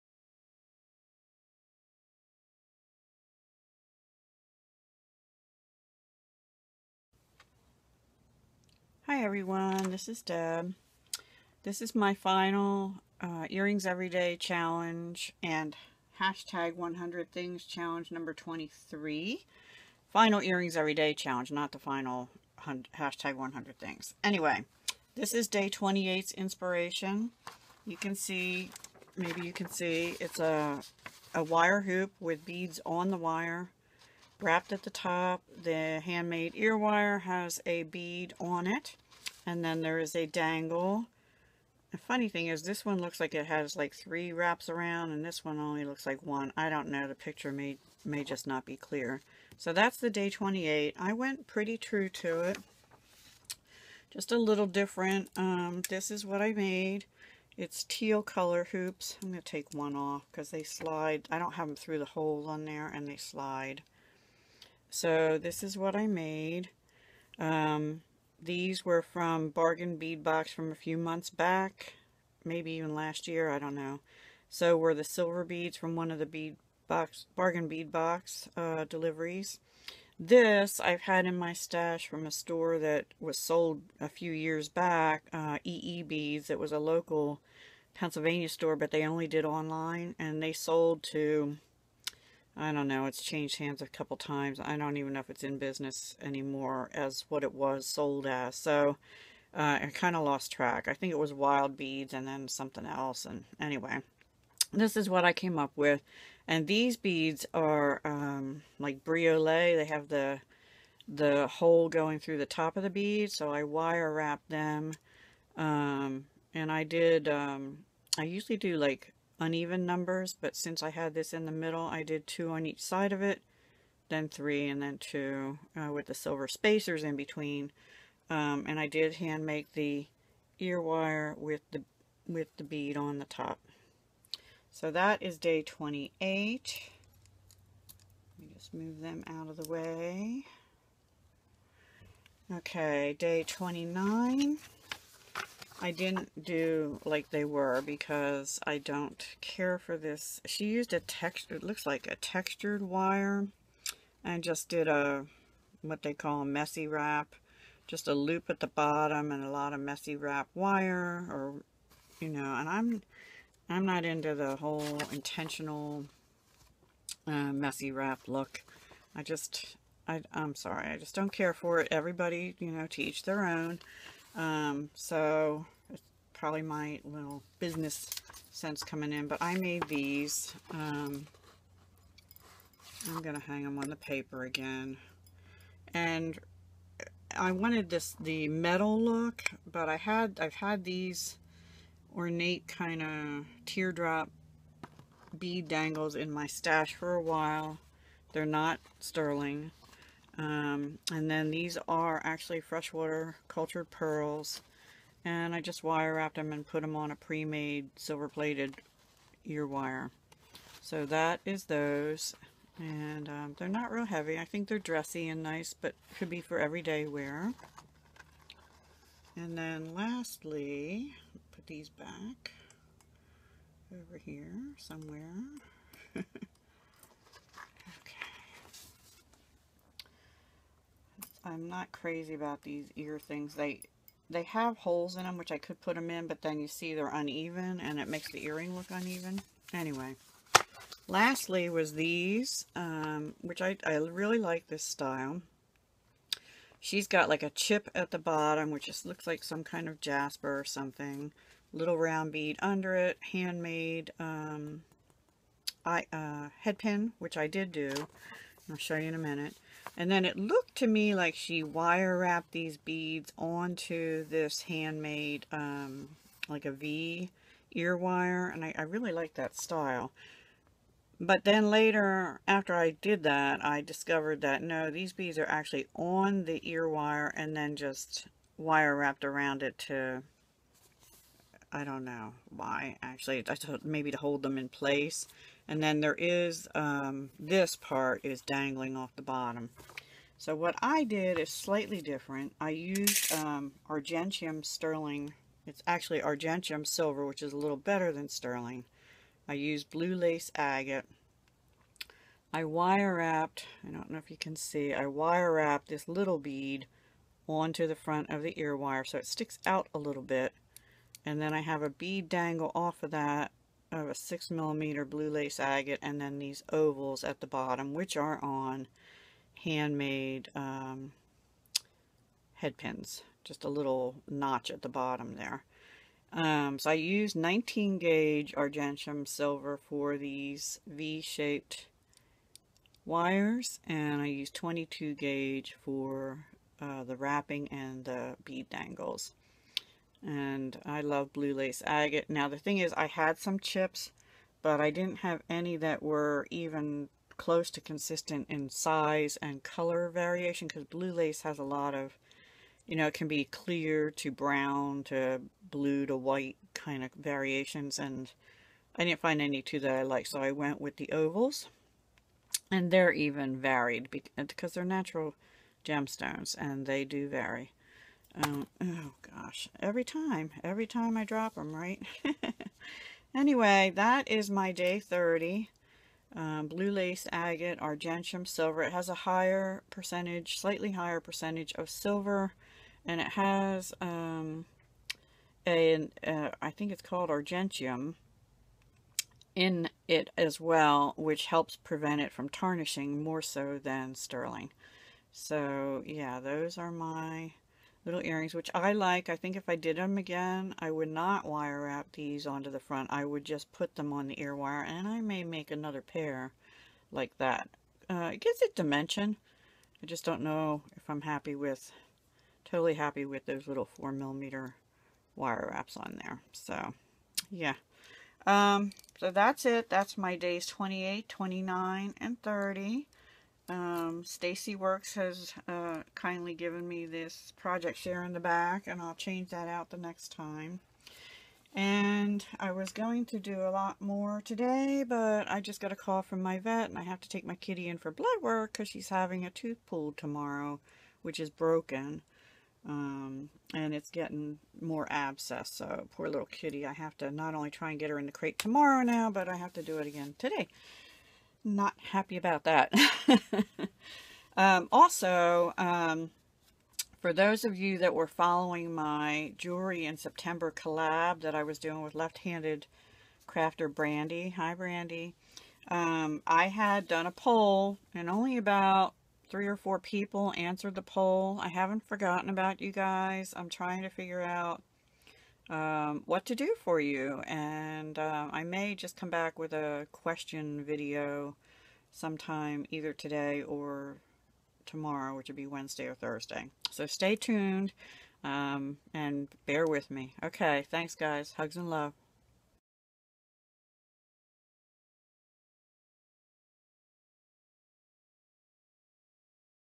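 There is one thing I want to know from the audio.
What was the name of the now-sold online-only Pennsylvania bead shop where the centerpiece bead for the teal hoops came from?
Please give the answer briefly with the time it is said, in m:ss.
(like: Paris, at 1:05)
EE Beads, at 1:25.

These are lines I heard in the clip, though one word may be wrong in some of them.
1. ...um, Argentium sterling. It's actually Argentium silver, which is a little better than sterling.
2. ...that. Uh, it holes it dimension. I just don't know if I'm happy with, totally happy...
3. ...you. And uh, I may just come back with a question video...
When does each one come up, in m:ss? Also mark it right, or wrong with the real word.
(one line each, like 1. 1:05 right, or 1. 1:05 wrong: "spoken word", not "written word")
1. 4:53 right
2. 6:47 wrong: "gives", not "holes"
3. 7:56 right.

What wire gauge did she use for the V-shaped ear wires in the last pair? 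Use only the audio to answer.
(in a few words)
19 gauge.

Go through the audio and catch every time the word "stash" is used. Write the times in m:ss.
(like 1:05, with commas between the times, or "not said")
1:21, 3:16.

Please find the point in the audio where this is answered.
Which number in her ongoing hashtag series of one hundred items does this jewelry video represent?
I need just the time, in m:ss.
0:18.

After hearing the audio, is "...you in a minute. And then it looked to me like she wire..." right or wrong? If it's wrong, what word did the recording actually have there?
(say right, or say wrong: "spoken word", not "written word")
right.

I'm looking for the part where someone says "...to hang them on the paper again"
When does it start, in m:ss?
3:03.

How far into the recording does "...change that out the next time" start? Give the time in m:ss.
7:09.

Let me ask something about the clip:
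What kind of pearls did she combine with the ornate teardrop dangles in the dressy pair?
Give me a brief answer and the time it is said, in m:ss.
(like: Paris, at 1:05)
freshwater cultured pearls, at 3:22.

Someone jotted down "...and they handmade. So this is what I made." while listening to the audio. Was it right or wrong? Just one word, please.
wrong.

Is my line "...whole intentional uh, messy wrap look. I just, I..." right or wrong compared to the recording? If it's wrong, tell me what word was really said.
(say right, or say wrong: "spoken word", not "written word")
right.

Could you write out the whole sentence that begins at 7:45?
Um, I had done a poll and only about three or four people answered the poll.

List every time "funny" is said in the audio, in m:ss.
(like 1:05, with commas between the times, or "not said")
0:41.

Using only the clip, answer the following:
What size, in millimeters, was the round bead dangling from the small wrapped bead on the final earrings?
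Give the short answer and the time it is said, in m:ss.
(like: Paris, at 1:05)
6 millimeter, at 5:14.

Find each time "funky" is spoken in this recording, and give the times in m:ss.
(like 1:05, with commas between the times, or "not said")
not said.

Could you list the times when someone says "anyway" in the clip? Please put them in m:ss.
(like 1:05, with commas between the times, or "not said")
0:24, 1:43, 3:59, 6:13.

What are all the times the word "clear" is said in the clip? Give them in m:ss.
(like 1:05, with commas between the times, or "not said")
0:48, 5:53.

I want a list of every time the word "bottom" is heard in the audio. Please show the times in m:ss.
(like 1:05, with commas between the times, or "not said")
2:38, 4:08, 4:49, 5:17, 5:24.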